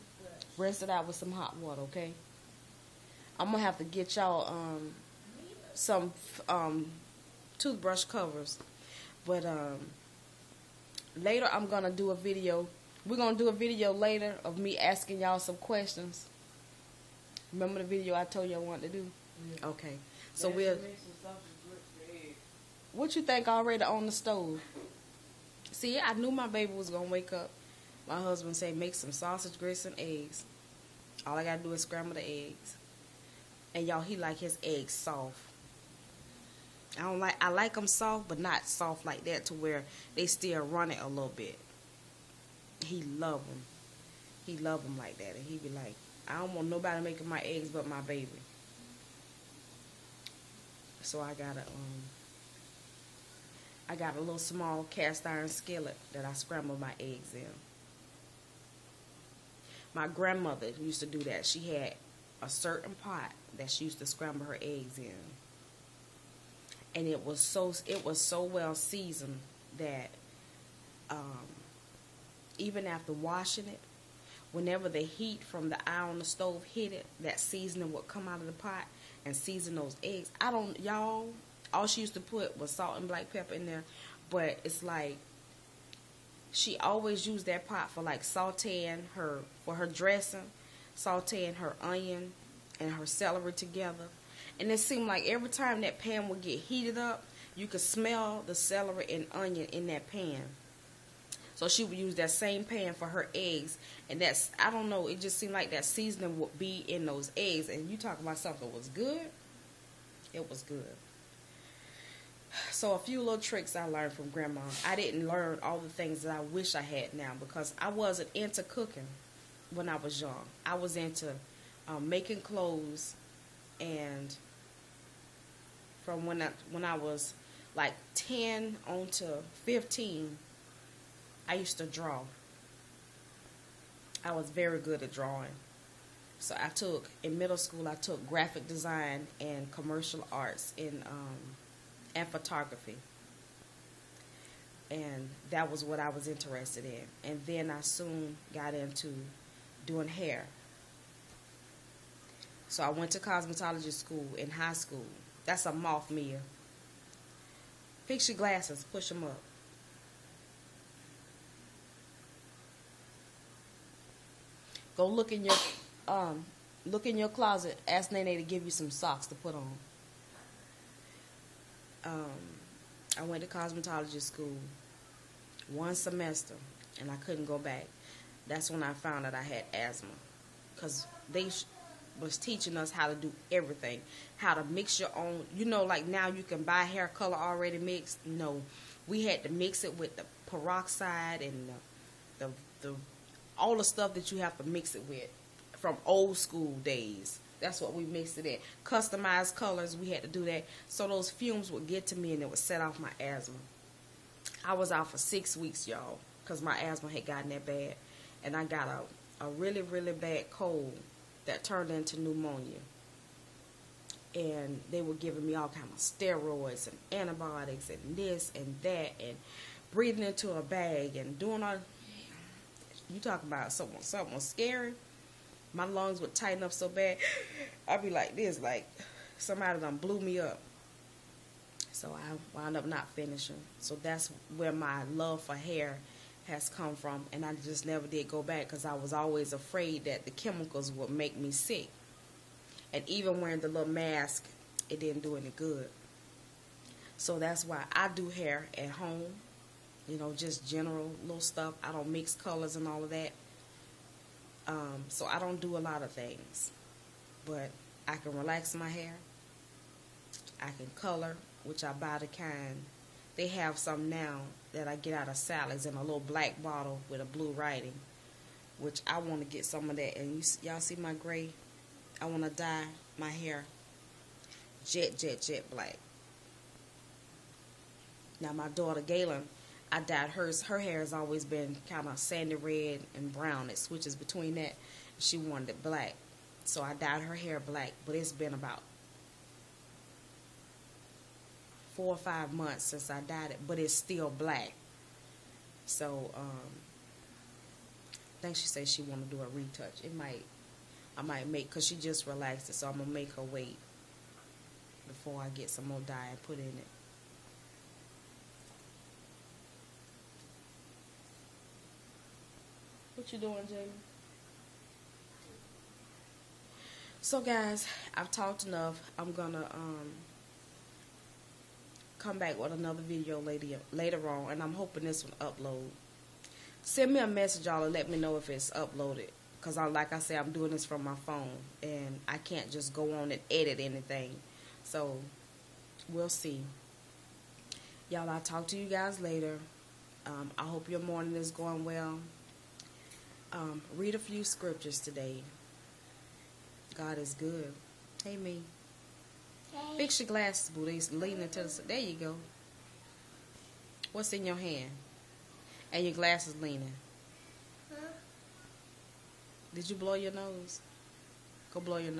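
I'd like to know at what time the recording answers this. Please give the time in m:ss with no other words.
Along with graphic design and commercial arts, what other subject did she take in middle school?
2:22.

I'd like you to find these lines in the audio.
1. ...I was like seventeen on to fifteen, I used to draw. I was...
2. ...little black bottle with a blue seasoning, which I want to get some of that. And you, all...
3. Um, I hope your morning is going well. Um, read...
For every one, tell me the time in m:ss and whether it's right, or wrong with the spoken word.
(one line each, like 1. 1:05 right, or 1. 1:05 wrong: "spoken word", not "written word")
1. 2:06 wrong: "ten", not "seventeen"
2. 4:26 wrong: "writing", not "seasoning"
3. 5:40 right.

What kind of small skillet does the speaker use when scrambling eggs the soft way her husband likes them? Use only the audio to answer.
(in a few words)
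Cast iron.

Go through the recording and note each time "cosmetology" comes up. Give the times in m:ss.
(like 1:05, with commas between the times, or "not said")
2:33, 2:53.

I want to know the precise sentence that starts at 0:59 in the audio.
My grandmother used to do that.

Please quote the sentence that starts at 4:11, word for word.
I don't mix colors and all of that.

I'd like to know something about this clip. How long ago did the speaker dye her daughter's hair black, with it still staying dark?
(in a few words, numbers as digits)
4 or 5 months.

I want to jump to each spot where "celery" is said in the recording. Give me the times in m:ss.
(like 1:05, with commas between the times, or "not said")
1:33, 1:38.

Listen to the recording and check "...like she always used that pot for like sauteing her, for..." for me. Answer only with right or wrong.
right.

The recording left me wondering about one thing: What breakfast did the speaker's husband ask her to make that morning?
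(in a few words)
Sausage, grits and eggs.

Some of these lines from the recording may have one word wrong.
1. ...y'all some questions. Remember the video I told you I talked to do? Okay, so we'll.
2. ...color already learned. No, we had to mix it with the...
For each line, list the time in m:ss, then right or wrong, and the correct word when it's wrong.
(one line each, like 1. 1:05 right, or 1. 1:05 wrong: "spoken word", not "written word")
1. 0:15 wrong: "wanted", not "talked"
2. 3:07 wrong: "mixed", not "learned".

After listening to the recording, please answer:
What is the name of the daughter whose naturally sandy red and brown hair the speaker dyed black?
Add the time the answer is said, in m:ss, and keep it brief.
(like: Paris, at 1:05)
Galen, at 4:39.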